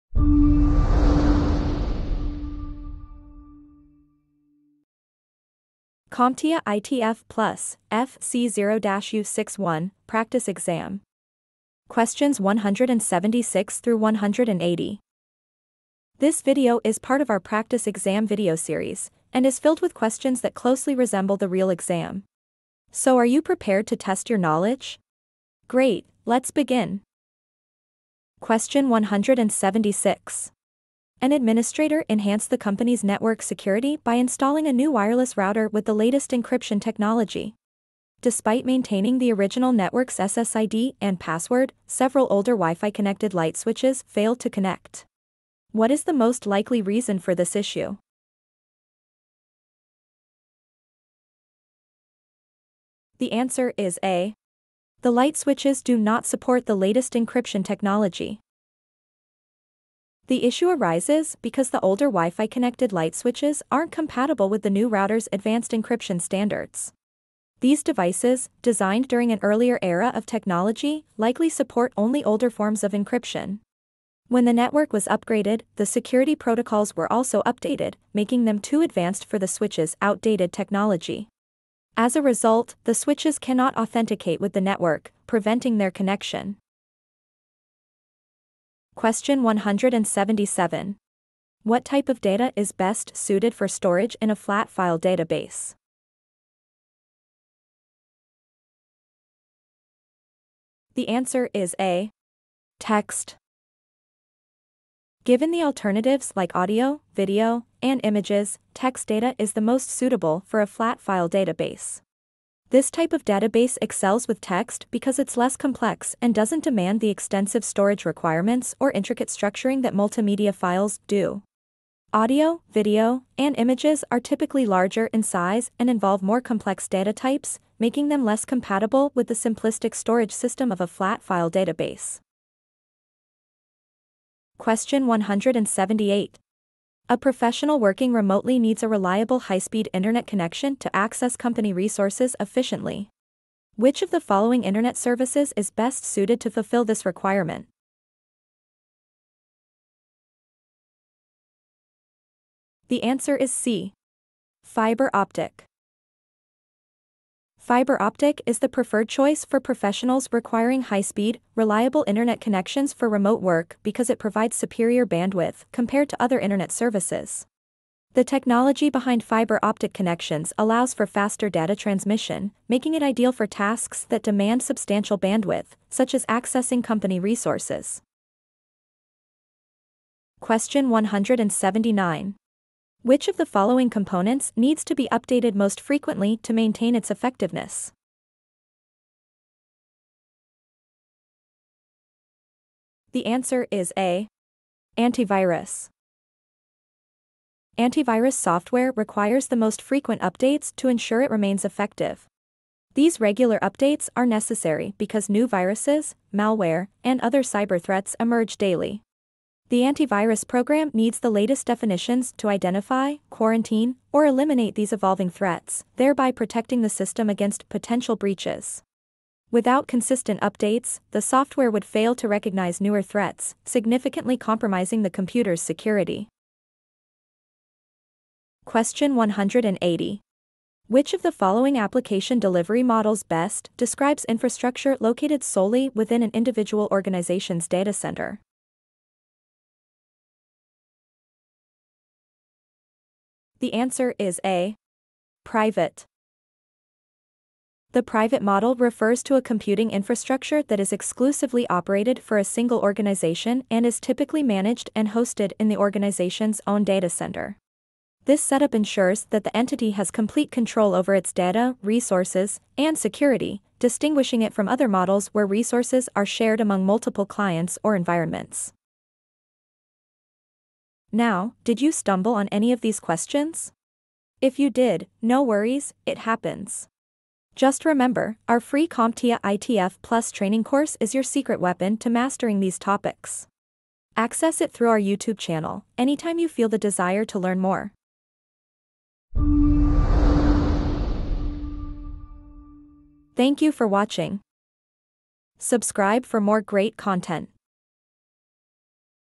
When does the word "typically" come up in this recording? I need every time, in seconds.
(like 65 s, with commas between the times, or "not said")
124 s, 253 s.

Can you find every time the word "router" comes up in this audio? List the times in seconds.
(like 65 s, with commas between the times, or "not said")
35 s, 64 s.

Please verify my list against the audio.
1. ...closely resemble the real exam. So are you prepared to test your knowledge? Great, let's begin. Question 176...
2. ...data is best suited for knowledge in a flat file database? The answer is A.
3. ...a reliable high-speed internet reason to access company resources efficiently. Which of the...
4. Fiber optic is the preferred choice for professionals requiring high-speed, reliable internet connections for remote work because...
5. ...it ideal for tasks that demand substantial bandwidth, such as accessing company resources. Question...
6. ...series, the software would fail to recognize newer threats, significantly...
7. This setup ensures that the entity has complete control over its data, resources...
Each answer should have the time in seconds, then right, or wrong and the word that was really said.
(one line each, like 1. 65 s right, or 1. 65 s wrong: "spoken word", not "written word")
1. 20 s right
2. 92 s wrong: "storage", not "knowledge"
3. 138 s wrong: "connection", not "reason"
4. 157 s right
5. 172 s right
6. 220 s wrong: "updates", not "series"
7. 258 s right.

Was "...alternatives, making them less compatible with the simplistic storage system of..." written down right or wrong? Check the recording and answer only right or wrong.
wrong.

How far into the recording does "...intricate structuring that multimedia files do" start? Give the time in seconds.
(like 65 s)
118 s.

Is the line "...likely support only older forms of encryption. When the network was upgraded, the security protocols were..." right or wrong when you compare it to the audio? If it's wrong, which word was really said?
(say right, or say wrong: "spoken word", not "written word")
right.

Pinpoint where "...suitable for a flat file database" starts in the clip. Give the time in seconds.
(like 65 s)
109 s.